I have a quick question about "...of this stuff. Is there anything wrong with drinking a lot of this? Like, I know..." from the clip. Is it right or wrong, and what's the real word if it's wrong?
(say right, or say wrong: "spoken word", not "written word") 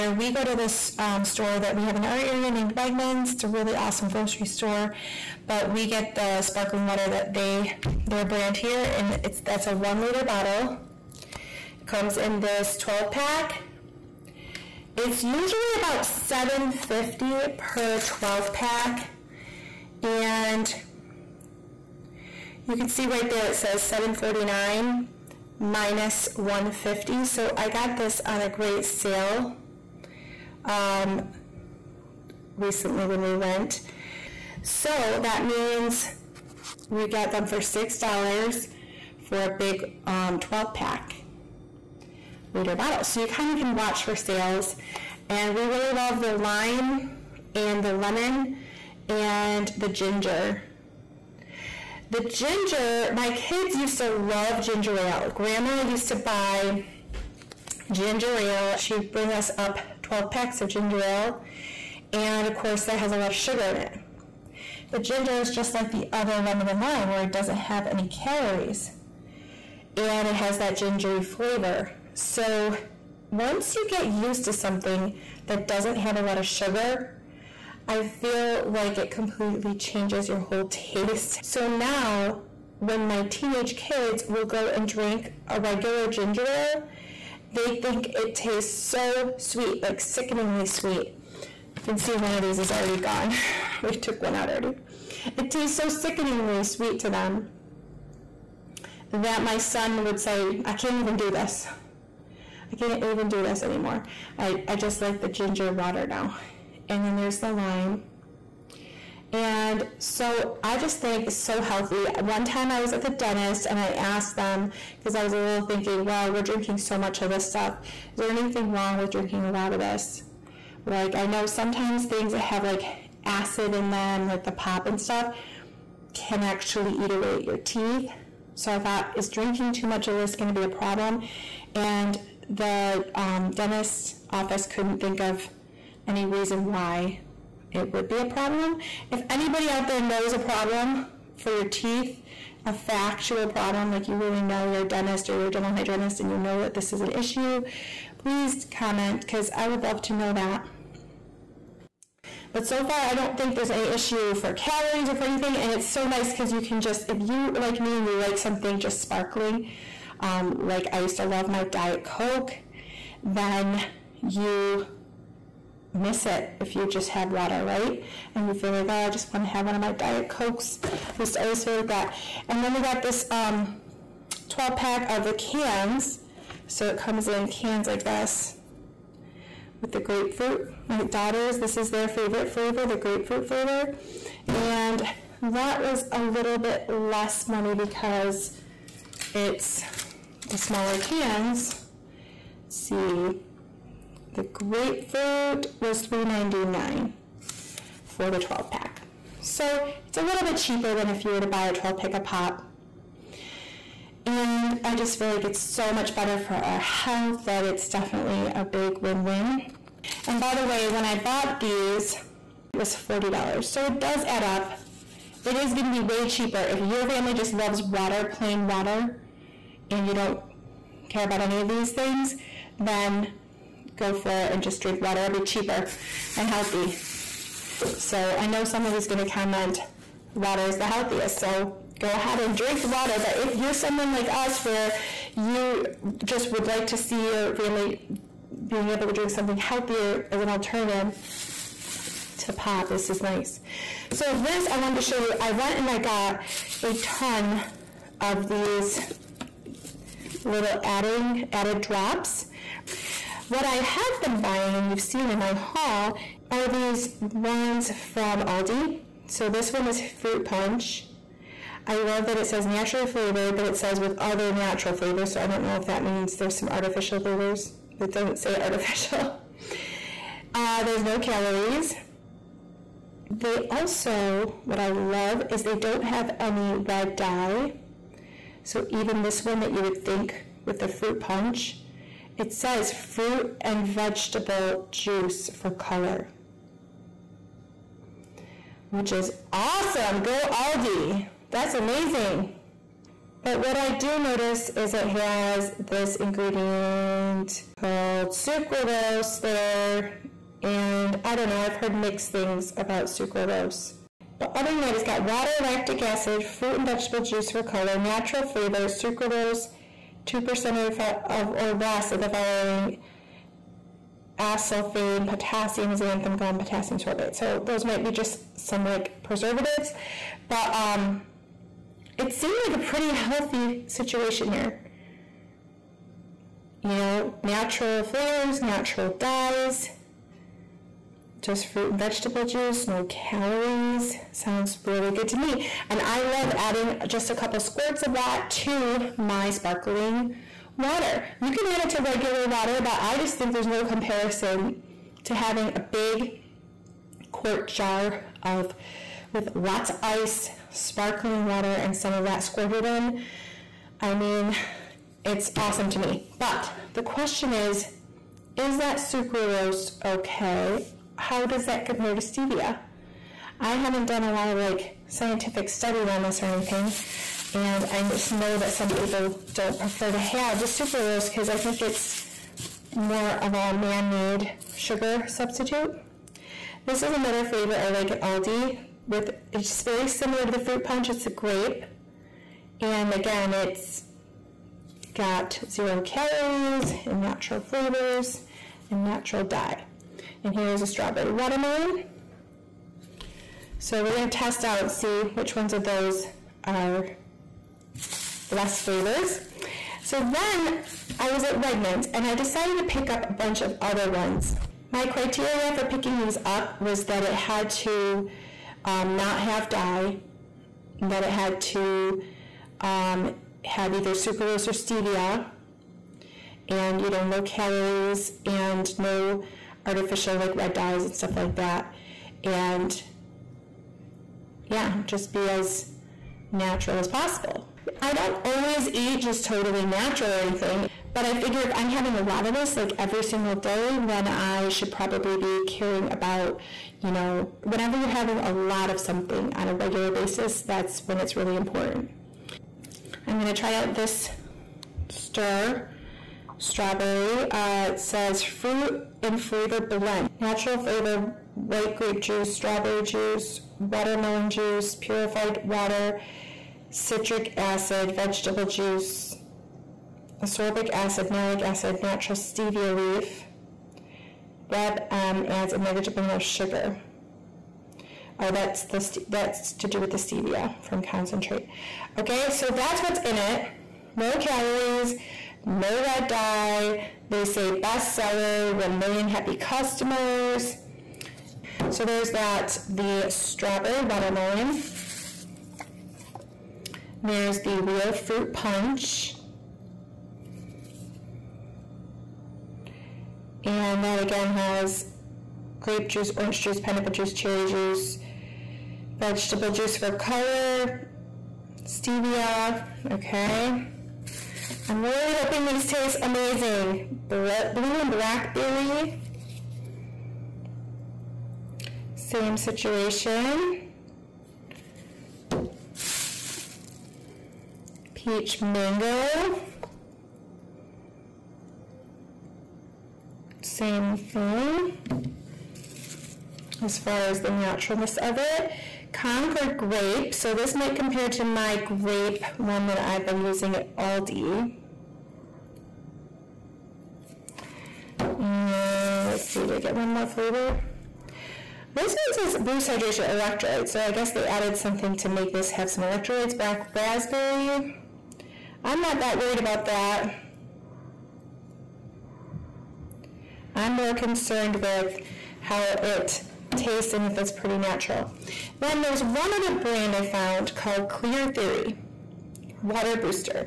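right.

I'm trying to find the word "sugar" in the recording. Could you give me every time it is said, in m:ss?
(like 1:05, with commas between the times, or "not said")
1:03, 1:16, 6:14, 7:46.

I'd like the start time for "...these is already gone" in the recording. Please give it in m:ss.
1:32.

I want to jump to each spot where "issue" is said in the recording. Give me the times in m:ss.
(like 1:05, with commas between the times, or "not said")
2:27, 2:33.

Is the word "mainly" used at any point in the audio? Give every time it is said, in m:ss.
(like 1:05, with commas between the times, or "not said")
not said.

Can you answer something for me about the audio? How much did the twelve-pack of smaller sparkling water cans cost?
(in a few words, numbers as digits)
$3.99.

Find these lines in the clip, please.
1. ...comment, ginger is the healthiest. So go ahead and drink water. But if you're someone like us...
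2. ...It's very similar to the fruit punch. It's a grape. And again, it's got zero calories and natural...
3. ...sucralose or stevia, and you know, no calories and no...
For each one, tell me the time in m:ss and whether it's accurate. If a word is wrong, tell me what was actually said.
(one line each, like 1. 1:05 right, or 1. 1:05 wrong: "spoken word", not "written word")
1. 3:49 wrong: "water", not "ginger"
2. 6:19 right
3. 6:54 right.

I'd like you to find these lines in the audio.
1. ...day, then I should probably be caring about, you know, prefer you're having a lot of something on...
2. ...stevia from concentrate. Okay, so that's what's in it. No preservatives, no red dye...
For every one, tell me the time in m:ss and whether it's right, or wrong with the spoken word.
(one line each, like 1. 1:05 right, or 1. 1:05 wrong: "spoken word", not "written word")
1. 7:13 wrong: "whenever", not "prefer"
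2. 7:50 wrong: "calories", not "preservatives".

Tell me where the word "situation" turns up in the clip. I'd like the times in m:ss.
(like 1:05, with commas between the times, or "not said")
5:23, 8:32.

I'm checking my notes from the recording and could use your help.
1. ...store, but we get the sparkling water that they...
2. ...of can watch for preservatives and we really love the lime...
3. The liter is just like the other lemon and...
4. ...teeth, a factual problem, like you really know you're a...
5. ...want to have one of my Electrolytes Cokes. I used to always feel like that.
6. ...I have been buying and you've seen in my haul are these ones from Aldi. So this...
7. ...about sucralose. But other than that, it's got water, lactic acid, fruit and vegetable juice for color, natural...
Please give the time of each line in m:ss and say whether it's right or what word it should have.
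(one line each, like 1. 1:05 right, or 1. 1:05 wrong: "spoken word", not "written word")
1. 0:04 right
2. 0:43 wrong: "sales", not "preservatives"
3. 1:04 wrong: "ginger", not "liter"
4. 2:21 right
5. 2:49 wrong: "Diet", not "Electrolytes"
6. 4:13 right
7. 5:02 right.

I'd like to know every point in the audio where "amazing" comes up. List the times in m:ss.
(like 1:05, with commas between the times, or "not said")
4:51, 8:26.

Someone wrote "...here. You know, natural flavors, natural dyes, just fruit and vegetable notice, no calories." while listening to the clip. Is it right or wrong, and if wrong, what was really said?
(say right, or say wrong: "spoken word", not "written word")
wrong: "juice", not "notice".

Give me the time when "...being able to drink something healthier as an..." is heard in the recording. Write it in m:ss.
3:58.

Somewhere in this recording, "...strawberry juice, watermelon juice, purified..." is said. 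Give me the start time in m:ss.
7:32.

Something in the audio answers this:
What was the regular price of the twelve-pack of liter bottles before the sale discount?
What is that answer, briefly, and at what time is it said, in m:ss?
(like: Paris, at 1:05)
$7.49, at 0:23.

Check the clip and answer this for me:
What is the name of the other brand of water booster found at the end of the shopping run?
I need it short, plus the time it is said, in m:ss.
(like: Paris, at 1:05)
Clear Theory, at 9:21.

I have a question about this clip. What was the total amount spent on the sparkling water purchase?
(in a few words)
$40.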